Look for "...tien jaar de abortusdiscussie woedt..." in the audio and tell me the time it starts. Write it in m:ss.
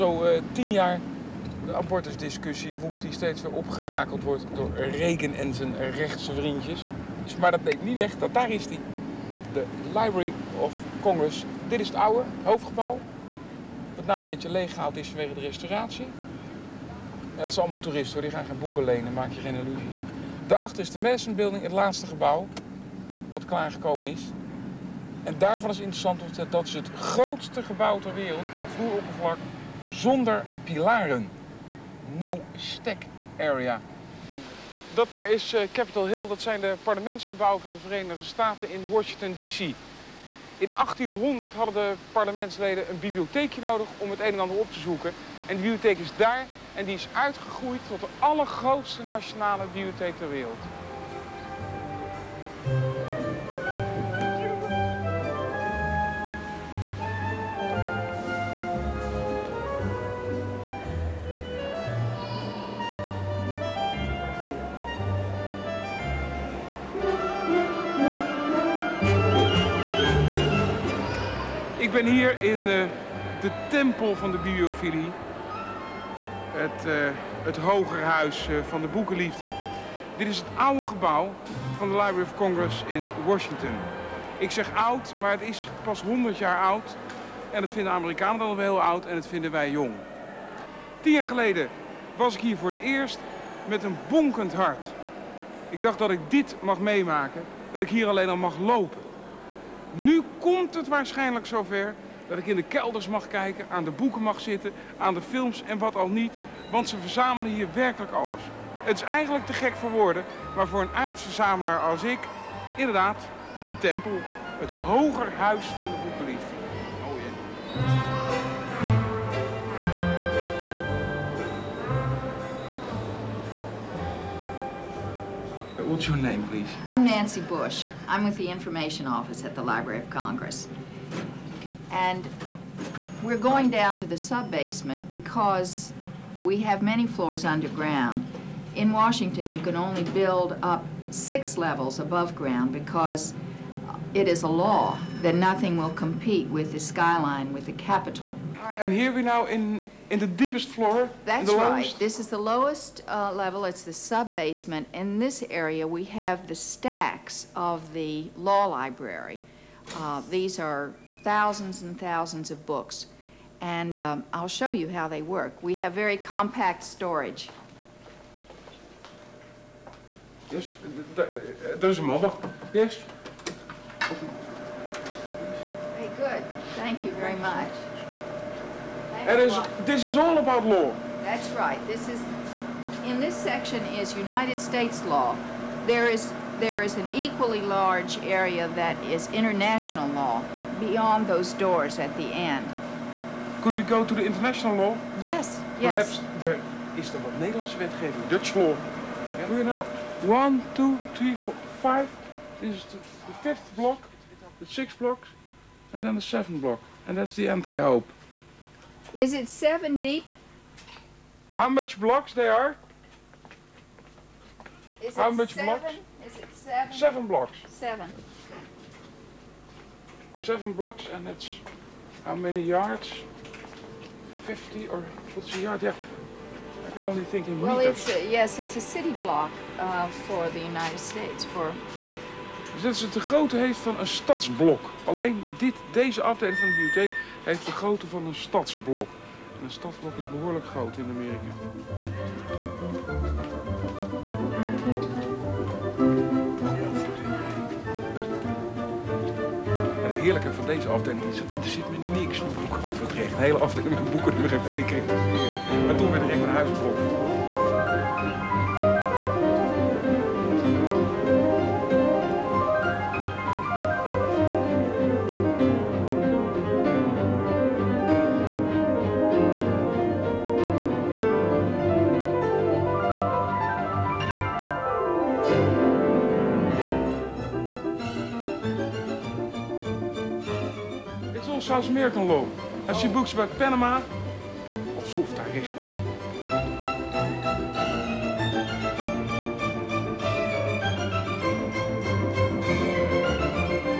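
0:00.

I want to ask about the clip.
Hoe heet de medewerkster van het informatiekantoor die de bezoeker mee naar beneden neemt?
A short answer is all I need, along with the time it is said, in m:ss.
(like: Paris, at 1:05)
Nancy Bush, at 2:07.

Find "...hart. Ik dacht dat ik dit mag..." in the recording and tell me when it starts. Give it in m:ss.
1:34.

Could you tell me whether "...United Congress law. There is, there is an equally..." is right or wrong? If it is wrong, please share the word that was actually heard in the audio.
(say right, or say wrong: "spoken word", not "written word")
wrong: "States", not "Congress".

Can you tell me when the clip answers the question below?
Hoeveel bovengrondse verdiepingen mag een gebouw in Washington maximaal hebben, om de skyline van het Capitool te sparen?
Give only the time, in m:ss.
2:21.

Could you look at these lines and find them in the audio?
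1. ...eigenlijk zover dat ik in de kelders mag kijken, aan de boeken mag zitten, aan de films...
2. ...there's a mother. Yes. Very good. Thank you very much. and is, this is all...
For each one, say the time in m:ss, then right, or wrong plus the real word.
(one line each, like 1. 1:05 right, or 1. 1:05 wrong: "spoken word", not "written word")
1. 1:40 wrong: "waarschijnlijk", not "eigenlijk"
2. 2:51 right.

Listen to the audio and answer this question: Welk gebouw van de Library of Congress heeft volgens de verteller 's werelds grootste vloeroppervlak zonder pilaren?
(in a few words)
Madison Building.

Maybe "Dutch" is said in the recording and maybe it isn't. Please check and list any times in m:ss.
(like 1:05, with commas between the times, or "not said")
3:18.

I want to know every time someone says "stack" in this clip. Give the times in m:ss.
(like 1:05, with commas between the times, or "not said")
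0:32, 2:36.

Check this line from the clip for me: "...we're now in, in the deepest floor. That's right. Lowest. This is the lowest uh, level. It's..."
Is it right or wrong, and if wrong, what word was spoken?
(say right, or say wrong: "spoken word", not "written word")
right.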